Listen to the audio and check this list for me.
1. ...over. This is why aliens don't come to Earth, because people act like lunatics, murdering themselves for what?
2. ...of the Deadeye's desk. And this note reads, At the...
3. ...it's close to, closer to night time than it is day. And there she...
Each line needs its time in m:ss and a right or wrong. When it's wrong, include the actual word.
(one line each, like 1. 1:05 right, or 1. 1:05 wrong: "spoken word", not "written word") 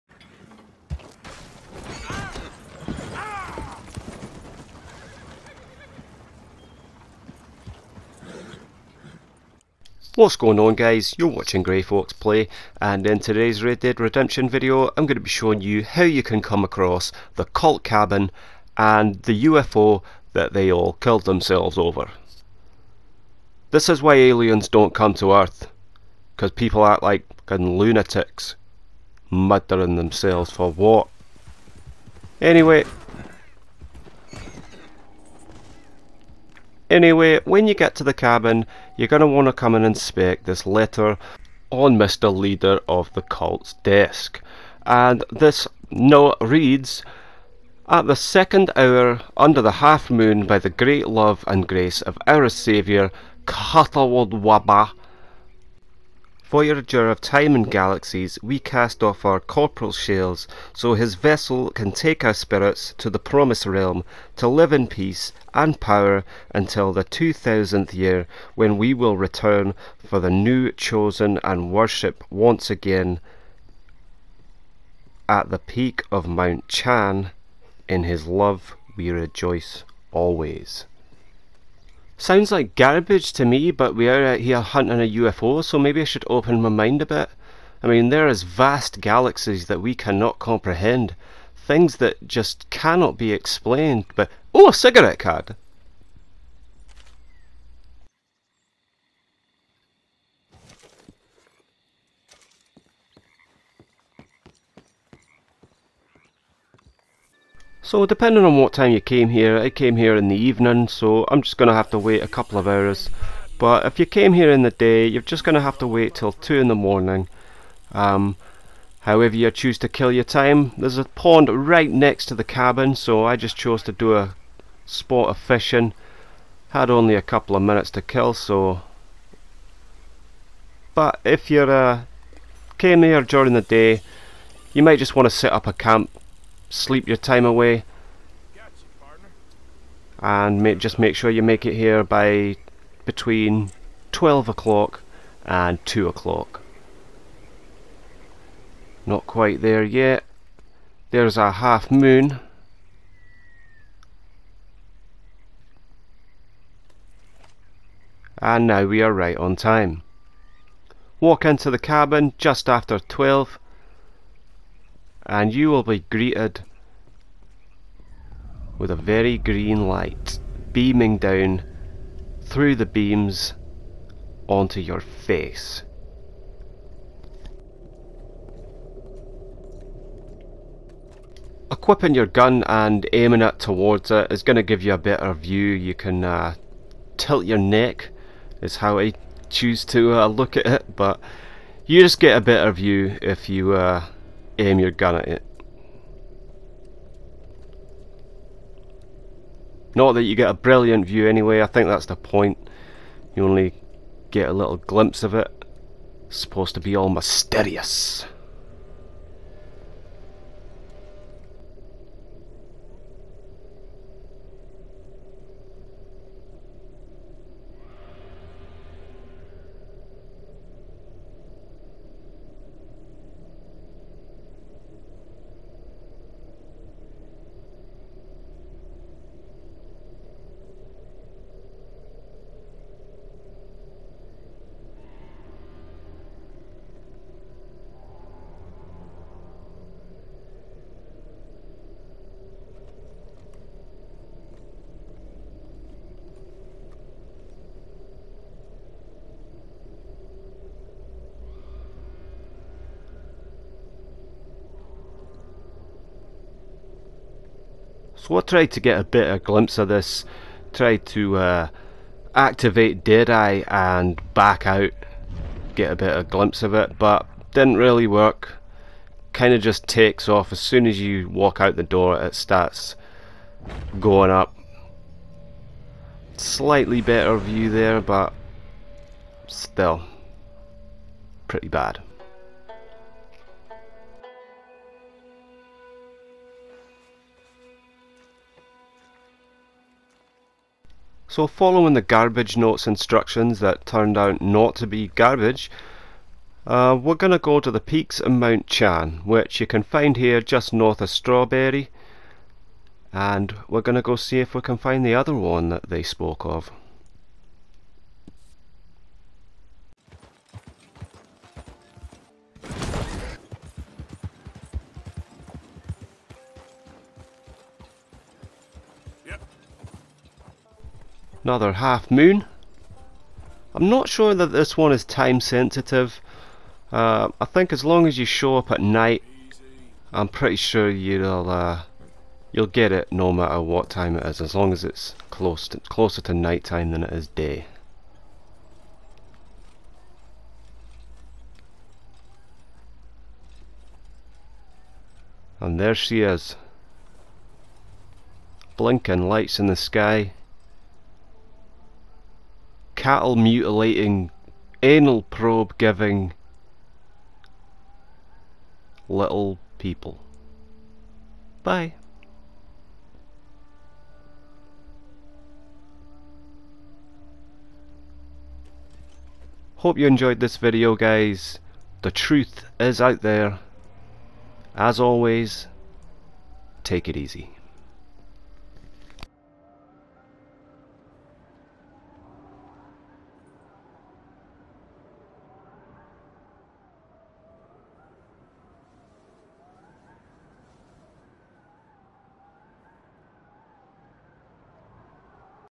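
1. 0:21 right
2. 0:42 wrong: "Cult", not "Deadeye"
3. 5:34 right.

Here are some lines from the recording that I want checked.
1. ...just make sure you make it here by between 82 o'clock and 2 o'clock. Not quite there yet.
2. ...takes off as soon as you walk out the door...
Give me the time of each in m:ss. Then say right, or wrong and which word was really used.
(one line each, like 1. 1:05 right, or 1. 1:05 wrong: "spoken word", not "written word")
1. 2:20 wrong: "12", not "82"
2. 4:29 right.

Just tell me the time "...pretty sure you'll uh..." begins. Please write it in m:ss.
5:30.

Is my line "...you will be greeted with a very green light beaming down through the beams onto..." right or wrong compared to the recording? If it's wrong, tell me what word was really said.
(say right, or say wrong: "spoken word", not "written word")
right.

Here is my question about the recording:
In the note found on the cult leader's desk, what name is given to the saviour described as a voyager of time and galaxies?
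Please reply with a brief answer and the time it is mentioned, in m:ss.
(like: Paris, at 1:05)
Catawald, at 0:53.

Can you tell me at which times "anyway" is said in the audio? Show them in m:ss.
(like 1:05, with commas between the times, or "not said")
0:32, 0:36, 3:21.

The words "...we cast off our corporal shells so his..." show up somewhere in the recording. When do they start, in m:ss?
0:58.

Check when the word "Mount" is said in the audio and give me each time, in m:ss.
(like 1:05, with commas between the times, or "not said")
1:16, 4:58.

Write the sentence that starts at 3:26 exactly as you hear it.
It's supposed to be all mysterious.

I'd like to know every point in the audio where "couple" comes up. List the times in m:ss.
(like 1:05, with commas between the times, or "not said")
1:52, 2:07.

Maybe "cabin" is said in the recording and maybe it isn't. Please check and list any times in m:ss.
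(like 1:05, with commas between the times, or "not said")
0:17, 0:38, 2:02, 2:41.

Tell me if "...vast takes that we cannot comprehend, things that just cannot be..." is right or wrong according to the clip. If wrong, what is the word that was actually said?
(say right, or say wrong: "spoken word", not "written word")
wrong: "galaxies", not "takes".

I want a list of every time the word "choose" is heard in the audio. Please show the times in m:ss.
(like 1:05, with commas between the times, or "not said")
1:59, 3:09.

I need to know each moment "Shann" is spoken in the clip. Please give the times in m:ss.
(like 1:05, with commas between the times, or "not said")
1:16, 4:58.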